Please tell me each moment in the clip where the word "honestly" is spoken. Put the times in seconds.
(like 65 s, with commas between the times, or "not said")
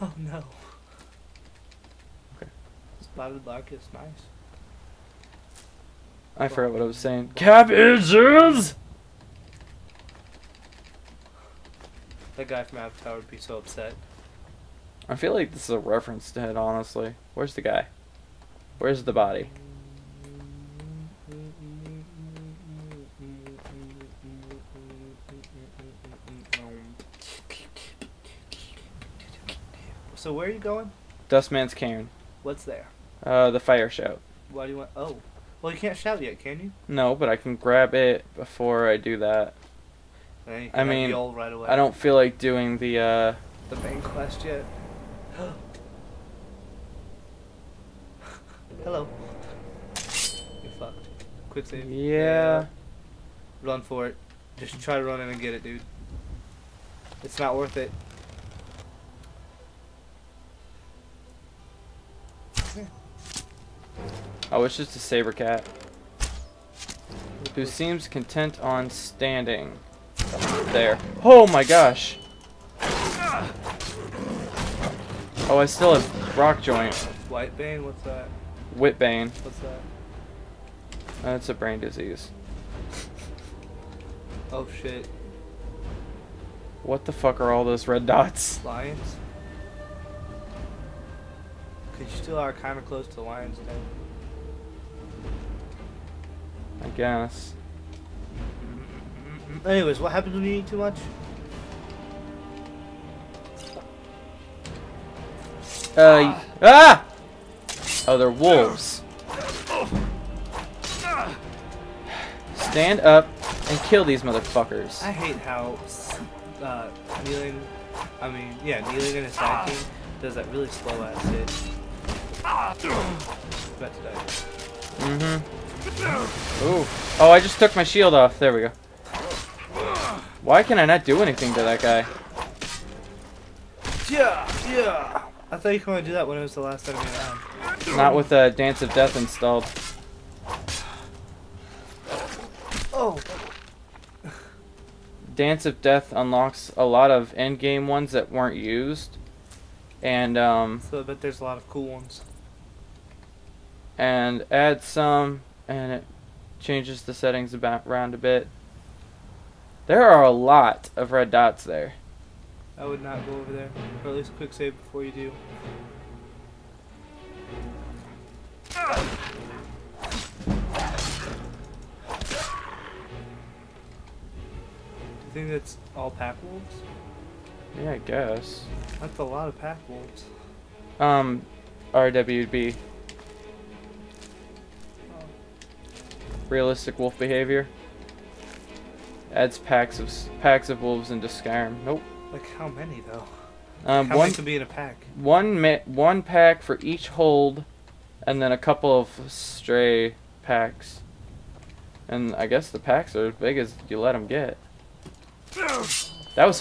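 16 s.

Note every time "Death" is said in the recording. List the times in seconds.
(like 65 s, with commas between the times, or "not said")
138 s, 145 s.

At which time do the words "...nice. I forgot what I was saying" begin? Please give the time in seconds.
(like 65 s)
3 s.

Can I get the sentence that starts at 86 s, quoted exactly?
What the fuck are all those red dots?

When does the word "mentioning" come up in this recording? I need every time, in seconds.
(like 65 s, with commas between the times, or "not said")
not said.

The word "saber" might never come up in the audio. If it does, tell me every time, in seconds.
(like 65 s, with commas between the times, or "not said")
64 s.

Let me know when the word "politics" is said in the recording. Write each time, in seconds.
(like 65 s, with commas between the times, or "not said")
not said.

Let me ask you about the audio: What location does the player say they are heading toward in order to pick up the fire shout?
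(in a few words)
Dustman's Cairn.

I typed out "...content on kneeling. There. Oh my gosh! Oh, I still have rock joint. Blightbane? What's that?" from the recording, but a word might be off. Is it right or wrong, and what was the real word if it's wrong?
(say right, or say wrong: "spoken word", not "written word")
wrong: "standing", not "kneeling".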